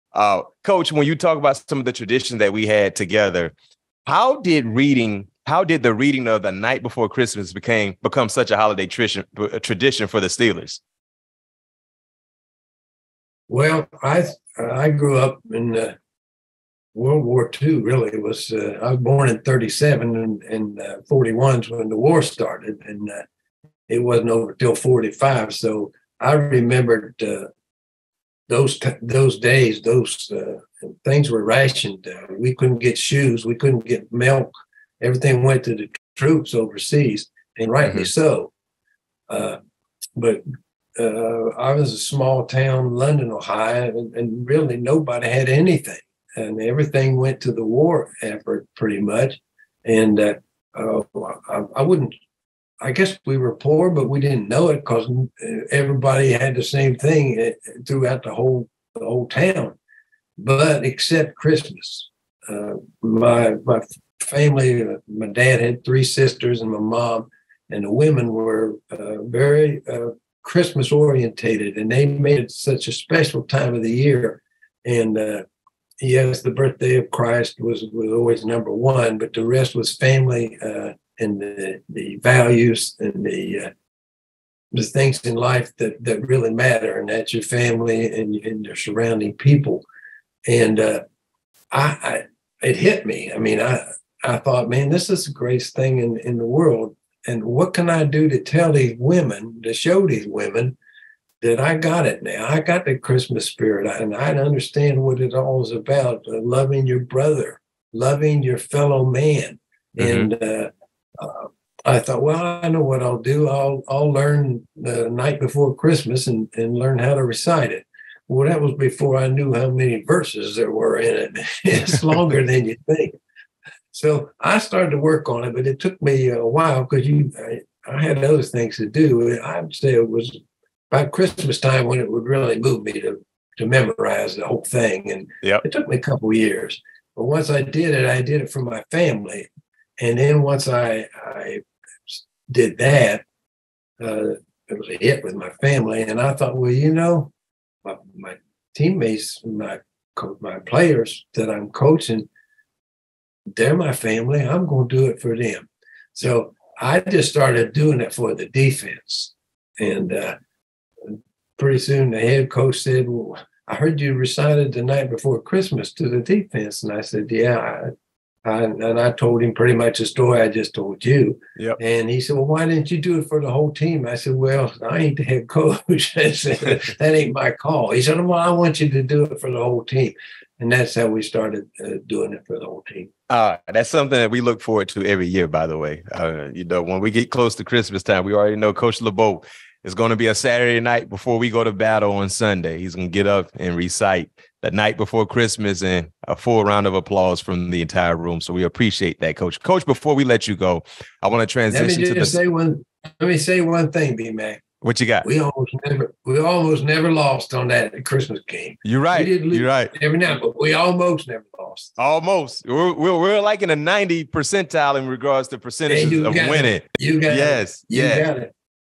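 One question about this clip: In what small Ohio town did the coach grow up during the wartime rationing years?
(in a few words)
London, Ohio.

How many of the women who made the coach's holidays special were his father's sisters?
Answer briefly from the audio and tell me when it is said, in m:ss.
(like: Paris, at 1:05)
3, at 1:05.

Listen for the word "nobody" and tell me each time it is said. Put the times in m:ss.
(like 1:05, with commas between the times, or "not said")
0:44.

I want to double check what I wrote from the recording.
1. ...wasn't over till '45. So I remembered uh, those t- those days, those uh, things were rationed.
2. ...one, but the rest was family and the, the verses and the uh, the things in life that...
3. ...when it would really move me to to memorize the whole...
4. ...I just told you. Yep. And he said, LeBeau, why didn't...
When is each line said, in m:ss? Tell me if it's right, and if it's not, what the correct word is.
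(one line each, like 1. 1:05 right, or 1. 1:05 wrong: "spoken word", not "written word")
1. 0:23 right
2. 1:18 wrong: "values", not "verses"
3. 2:11 right
4. 2:50 wrong: "Well", not "LeBeau".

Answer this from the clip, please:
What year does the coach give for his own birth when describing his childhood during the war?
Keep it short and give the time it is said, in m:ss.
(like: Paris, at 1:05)
1937, at 0:19.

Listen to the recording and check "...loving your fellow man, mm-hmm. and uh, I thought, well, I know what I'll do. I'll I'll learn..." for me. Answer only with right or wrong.
right.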